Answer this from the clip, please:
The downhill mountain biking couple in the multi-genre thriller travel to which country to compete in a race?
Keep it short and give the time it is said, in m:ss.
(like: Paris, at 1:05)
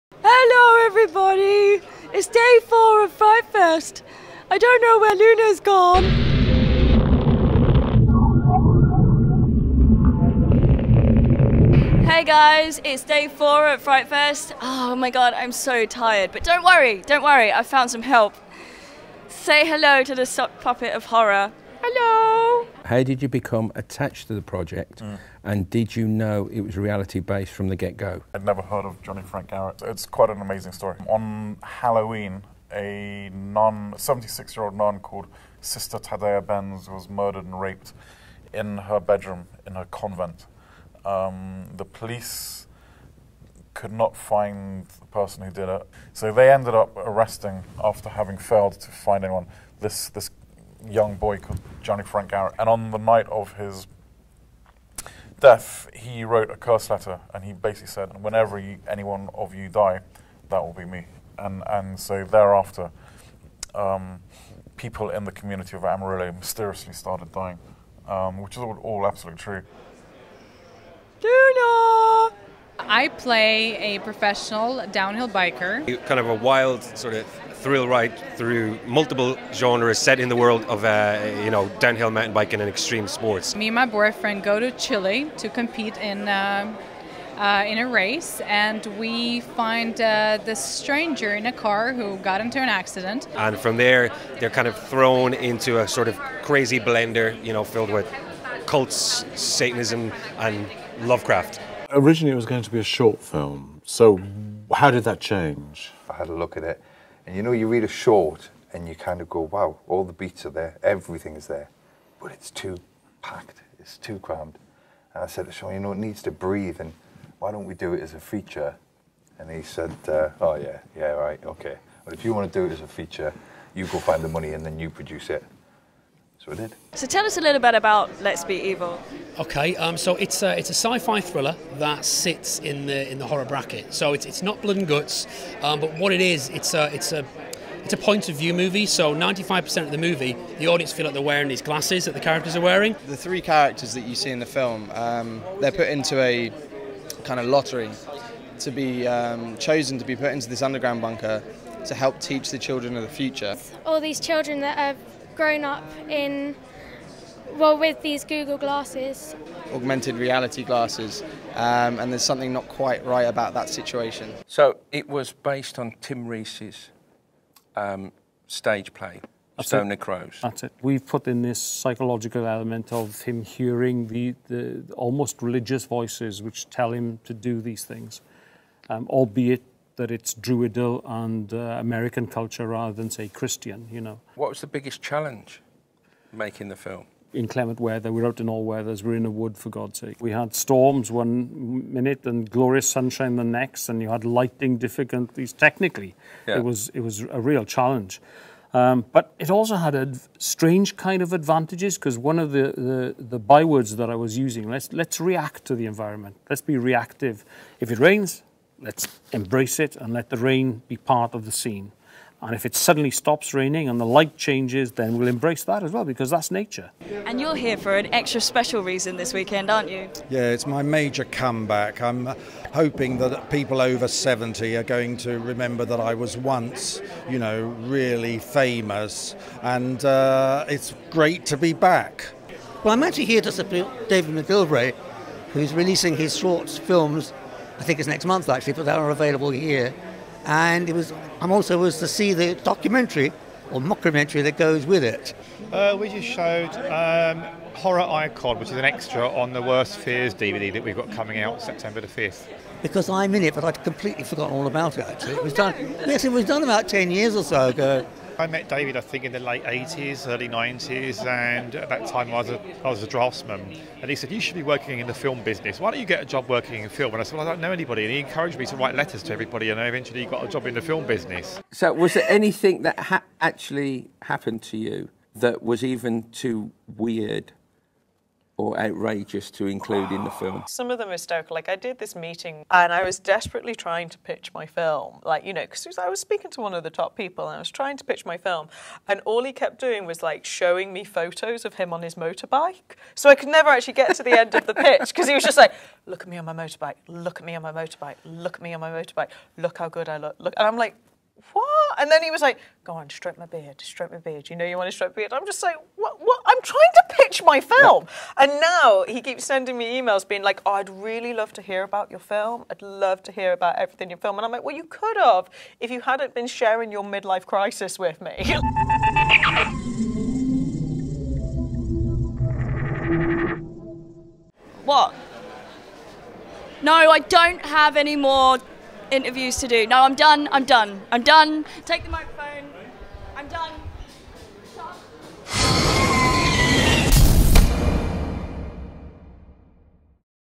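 Chile, at 1:24.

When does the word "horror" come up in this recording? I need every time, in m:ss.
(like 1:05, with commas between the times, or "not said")
0:21, 2:13, 4:07.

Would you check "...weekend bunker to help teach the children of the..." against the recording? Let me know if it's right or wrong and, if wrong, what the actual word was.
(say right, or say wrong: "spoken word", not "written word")
wrong: "underground", not "weekend".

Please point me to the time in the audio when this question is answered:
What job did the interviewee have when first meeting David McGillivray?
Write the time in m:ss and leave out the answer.
4:23.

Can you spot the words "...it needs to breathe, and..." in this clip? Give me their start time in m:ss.
1:55.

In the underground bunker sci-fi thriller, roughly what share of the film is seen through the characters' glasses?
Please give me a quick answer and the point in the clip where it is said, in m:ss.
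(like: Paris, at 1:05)
95%, at 2:19.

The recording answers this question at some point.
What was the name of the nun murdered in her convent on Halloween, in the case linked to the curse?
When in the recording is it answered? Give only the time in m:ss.
0:35.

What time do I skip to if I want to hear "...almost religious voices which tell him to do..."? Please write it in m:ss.
2:54.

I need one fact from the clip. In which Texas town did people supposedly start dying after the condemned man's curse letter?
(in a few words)
Amarillo.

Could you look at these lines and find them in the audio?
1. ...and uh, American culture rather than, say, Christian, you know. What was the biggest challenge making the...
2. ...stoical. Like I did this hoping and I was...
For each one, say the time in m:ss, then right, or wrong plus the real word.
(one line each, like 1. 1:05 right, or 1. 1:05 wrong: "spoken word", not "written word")
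1. 3:01 right
2. 4:41 wrong: "meeting", not "hoping".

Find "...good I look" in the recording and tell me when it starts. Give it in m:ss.
4:59.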